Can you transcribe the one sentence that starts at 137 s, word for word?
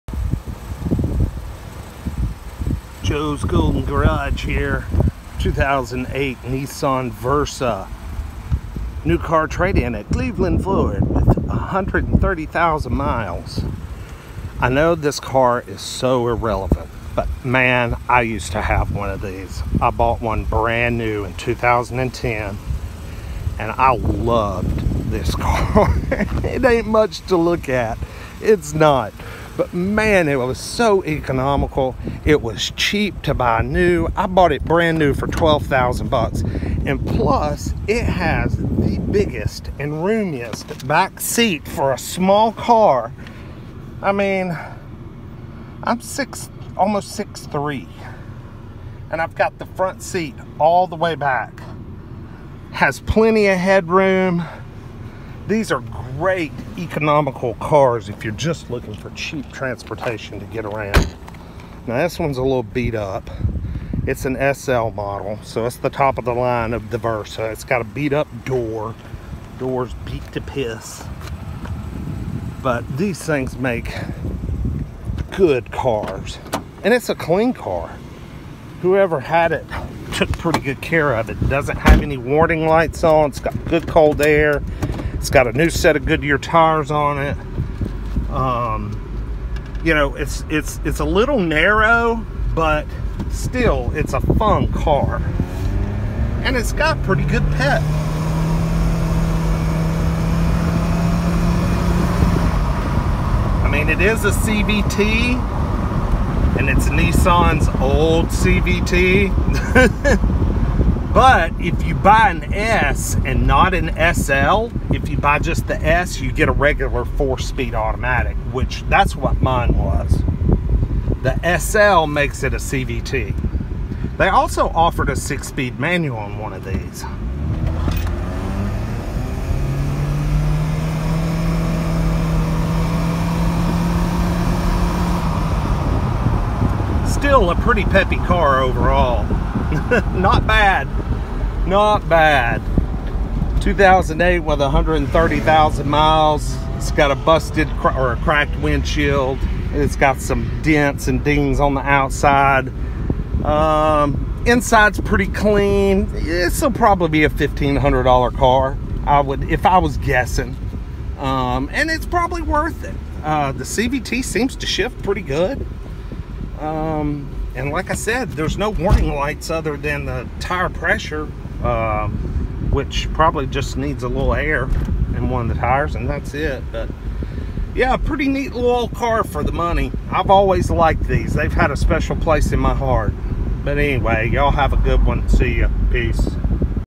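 Still a pretty peppy car overall.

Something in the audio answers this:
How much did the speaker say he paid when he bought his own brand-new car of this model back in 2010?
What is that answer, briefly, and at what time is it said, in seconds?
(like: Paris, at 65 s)
$12,000, at 35 s.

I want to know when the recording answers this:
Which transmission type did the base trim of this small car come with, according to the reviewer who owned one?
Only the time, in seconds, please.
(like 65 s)
117 s.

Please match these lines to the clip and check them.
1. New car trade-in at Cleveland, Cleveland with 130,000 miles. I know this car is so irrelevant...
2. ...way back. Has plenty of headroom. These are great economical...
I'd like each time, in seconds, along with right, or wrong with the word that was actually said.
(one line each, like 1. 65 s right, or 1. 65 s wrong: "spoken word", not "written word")
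1. 9 s wrong: "Florida", not "Cleveland"
2. 50 s right.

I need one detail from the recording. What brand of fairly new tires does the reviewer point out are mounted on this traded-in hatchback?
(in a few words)
Goodyear.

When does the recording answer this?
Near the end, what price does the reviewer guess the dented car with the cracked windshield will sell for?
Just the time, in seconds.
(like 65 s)
157 s.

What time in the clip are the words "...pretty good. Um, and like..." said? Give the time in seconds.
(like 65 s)
165 s.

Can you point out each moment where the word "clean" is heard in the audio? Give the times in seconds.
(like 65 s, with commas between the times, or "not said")
77 s, 155 s.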